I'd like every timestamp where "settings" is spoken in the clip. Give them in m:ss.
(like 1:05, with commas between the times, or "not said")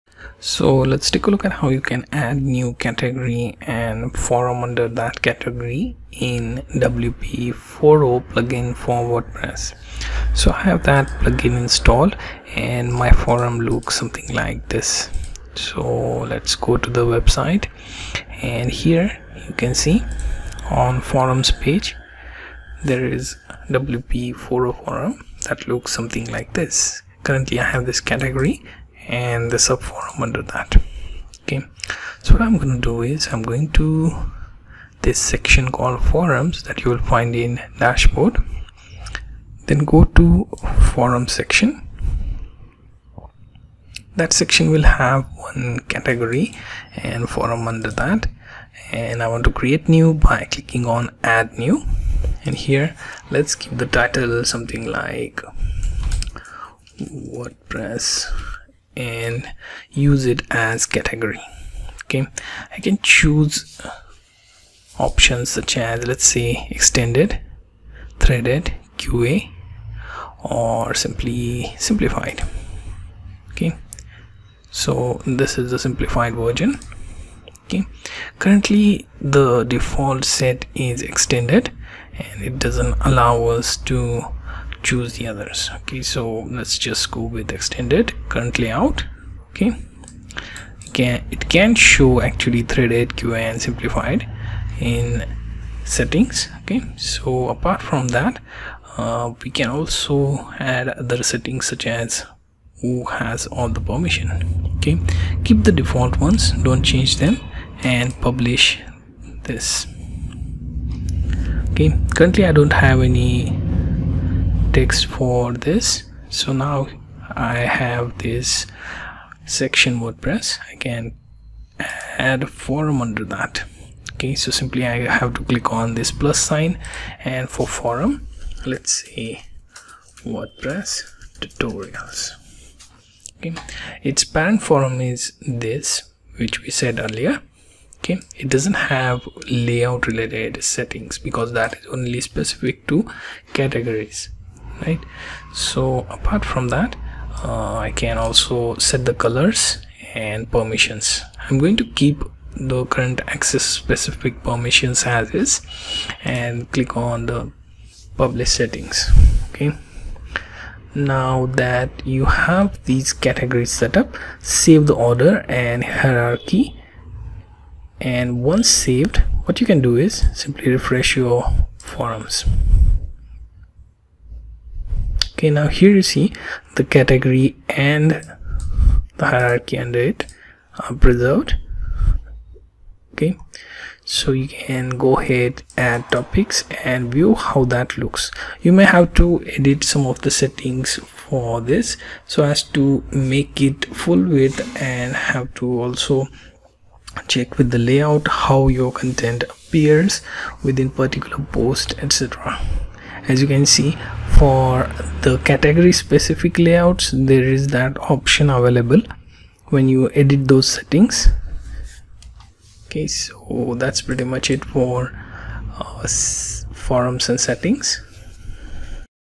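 1:35, 1:41, 2:20, 2:38, 3:10, 3:30, 3:37.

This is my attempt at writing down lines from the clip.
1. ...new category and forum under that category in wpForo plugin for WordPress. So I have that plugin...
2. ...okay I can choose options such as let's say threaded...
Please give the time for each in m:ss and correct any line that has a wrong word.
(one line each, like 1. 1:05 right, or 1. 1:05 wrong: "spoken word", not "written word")
1. 0:02 right
2. 1:02 wrong: "extended", not "threaded".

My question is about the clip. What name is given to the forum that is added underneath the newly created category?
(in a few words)
WordPress tutorials.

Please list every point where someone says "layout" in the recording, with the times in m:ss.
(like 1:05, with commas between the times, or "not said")
1:28, 2:19, 3:17, 3:26.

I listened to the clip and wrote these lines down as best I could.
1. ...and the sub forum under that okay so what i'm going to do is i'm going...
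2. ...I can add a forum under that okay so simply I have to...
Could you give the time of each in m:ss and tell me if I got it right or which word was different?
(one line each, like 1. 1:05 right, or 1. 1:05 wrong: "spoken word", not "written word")
1. 0:29 right
2. 2:00 right.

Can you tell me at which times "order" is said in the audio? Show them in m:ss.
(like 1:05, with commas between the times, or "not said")
2:44.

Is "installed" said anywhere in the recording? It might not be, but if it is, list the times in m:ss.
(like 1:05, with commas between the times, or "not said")
0:11.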